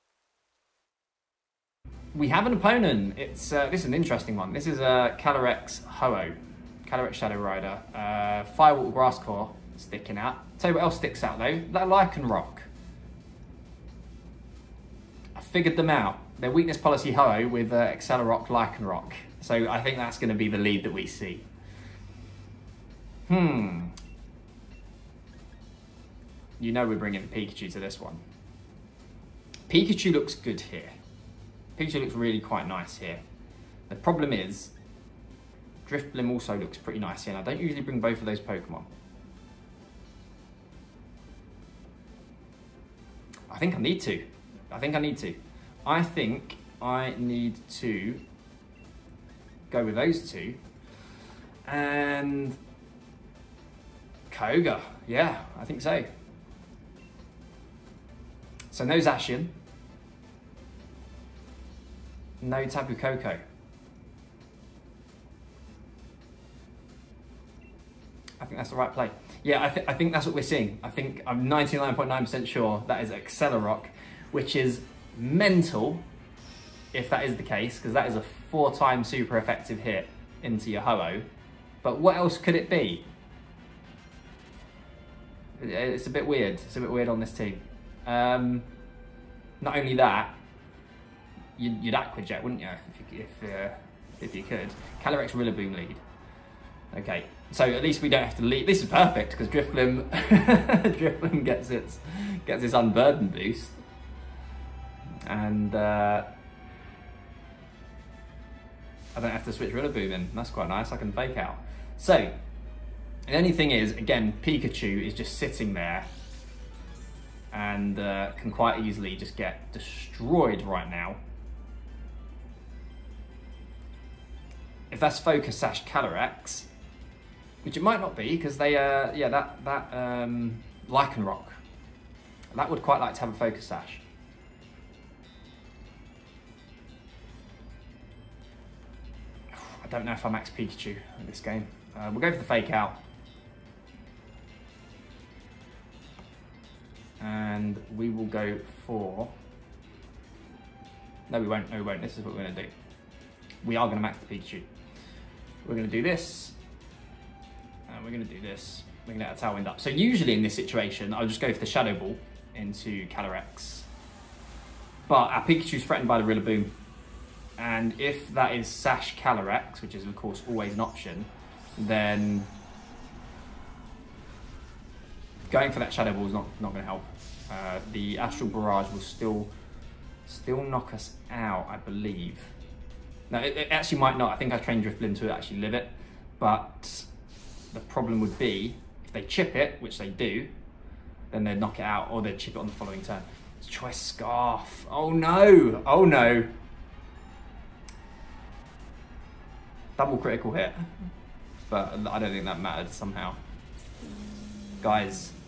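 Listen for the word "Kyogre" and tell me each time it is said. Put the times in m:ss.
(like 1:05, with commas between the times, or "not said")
0:54.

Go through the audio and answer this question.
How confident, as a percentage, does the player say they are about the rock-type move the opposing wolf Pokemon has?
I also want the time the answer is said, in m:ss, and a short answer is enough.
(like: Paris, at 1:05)
99.9%, at 1:11.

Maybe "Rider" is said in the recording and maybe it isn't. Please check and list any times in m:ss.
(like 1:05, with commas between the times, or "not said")
0:07.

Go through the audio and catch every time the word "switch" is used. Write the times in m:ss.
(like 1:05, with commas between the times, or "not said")
1:49.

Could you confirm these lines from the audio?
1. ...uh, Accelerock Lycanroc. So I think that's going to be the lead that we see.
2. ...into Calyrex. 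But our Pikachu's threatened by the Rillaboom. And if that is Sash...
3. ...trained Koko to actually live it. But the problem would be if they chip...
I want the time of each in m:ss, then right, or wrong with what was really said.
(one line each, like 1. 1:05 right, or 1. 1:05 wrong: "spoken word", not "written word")
1. 0:17 right
2. 2:42 right
3. 3:04 wrong: "Drifblim", not "Koko".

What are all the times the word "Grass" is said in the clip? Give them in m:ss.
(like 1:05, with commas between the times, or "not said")
0:08.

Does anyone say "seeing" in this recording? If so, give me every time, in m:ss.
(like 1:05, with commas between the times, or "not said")
1:10.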